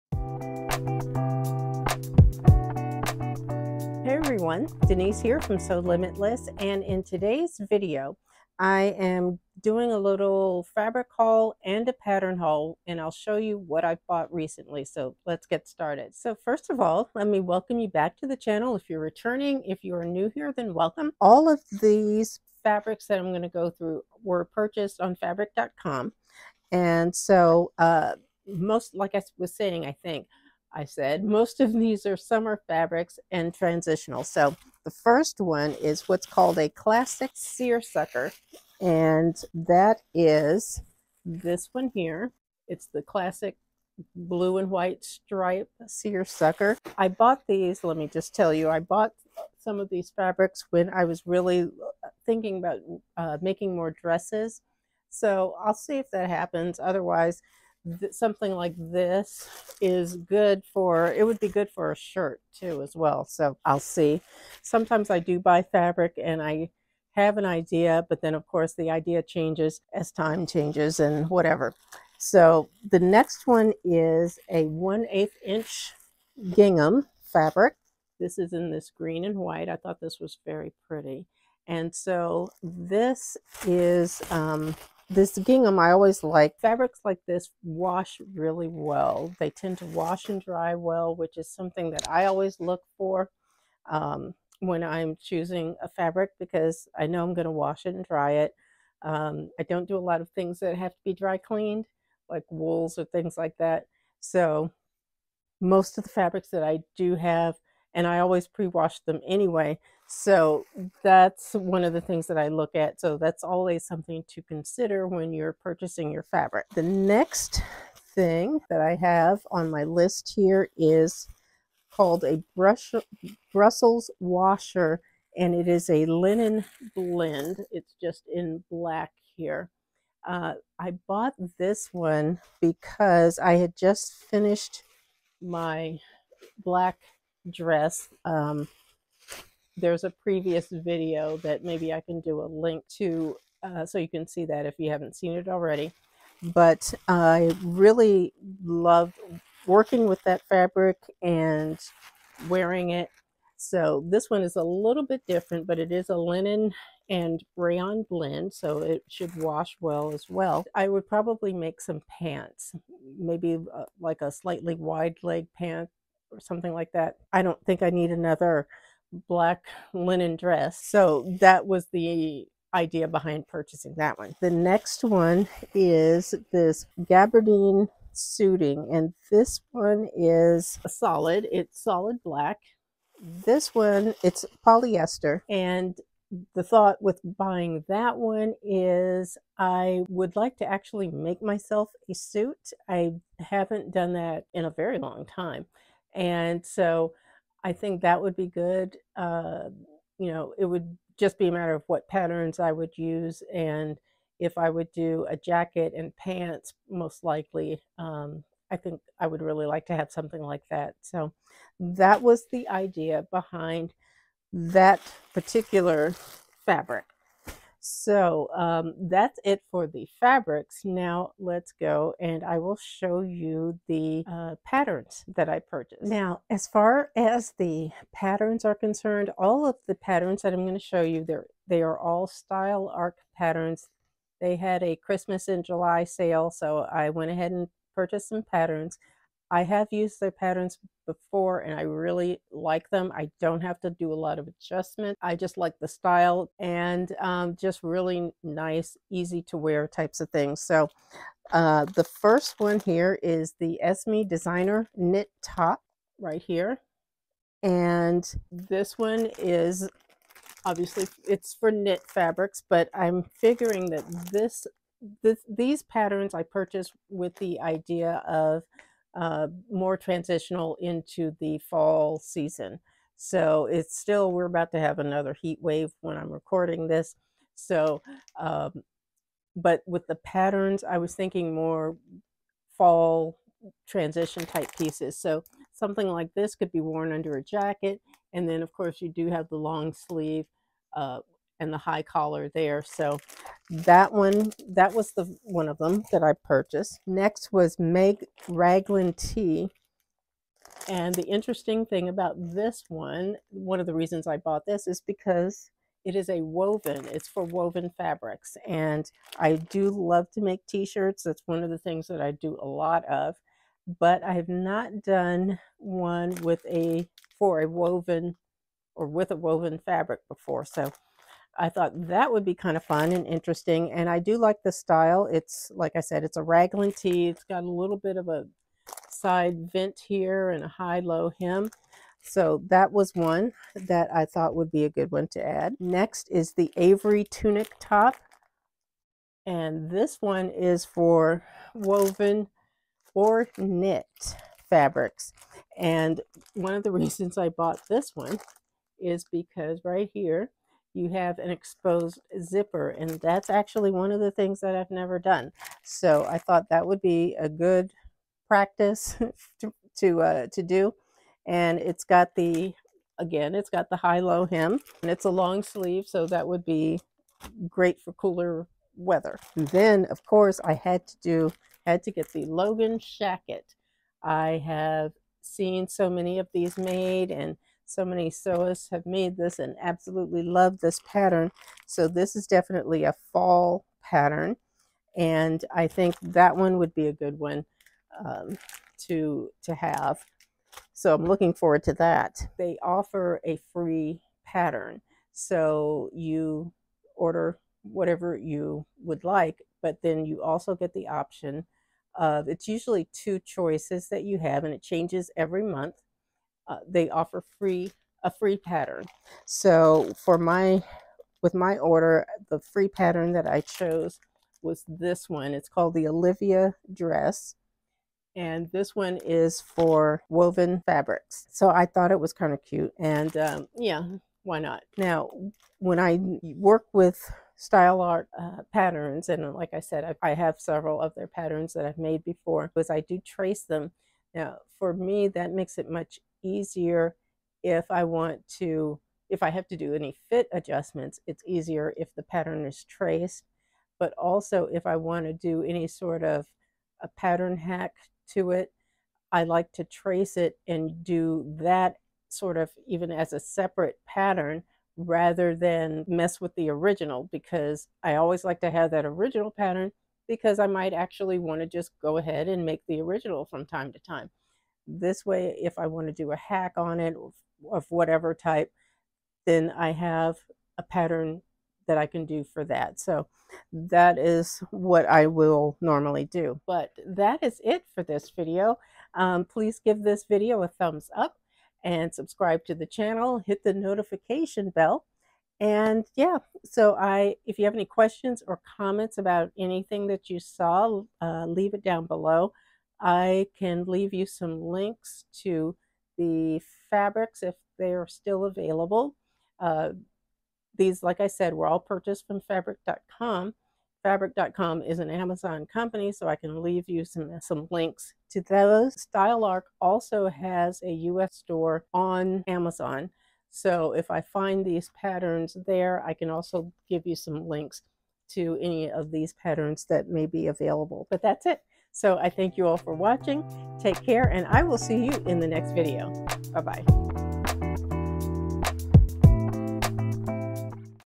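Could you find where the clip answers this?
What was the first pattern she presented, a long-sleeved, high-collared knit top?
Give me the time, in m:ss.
4:13.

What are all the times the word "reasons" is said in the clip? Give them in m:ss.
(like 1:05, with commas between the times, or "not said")
5:03, 5:46.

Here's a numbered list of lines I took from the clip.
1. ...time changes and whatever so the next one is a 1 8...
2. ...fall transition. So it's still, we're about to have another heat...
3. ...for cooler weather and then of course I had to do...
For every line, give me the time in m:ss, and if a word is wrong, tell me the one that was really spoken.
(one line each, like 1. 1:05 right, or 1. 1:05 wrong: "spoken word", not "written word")
1. 1:10 right
2. 4:31 wrong: "season", not "transition"
3. 6:08 right.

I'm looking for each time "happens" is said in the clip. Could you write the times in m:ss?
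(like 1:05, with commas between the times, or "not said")
0:56.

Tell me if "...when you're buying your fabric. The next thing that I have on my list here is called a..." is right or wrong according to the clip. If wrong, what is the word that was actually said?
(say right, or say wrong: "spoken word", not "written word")
wrong: "purchasing", not "buying".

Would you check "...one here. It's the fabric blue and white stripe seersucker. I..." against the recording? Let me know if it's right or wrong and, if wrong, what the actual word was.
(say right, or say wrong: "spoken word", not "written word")
wrong: "classic", not "fabric".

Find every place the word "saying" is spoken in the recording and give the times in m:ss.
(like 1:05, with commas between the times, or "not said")
0:29.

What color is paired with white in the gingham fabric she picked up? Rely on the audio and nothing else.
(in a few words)
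Green.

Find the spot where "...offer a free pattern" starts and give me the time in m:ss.
6:32.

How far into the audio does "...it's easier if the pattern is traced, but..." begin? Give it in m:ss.
7:21.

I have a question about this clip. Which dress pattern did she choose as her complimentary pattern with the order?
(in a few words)
Olivia dress.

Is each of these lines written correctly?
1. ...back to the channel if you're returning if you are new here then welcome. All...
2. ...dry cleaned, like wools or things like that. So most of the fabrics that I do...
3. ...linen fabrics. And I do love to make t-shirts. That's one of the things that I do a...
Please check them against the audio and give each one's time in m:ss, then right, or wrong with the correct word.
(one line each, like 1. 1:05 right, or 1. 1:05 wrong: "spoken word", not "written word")
1. 0:17 right
2. 1:41 right
3. 5:07 wrong: "woven", not "linen".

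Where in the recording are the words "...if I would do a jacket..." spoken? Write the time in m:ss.
3:24.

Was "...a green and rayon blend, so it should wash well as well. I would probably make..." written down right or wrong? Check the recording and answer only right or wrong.
wrong.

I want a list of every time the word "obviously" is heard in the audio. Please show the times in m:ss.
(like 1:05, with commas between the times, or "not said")
4:20.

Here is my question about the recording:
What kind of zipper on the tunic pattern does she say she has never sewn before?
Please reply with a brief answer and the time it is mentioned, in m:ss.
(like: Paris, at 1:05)
Exposed zipper, at 5:51.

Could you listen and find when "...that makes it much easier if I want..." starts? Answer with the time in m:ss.
7:15.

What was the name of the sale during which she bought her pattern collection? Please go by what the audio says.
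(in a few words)
Christmas in July.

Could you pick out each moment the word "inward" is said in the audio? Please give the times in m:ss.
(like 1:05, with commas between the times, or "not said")
not said.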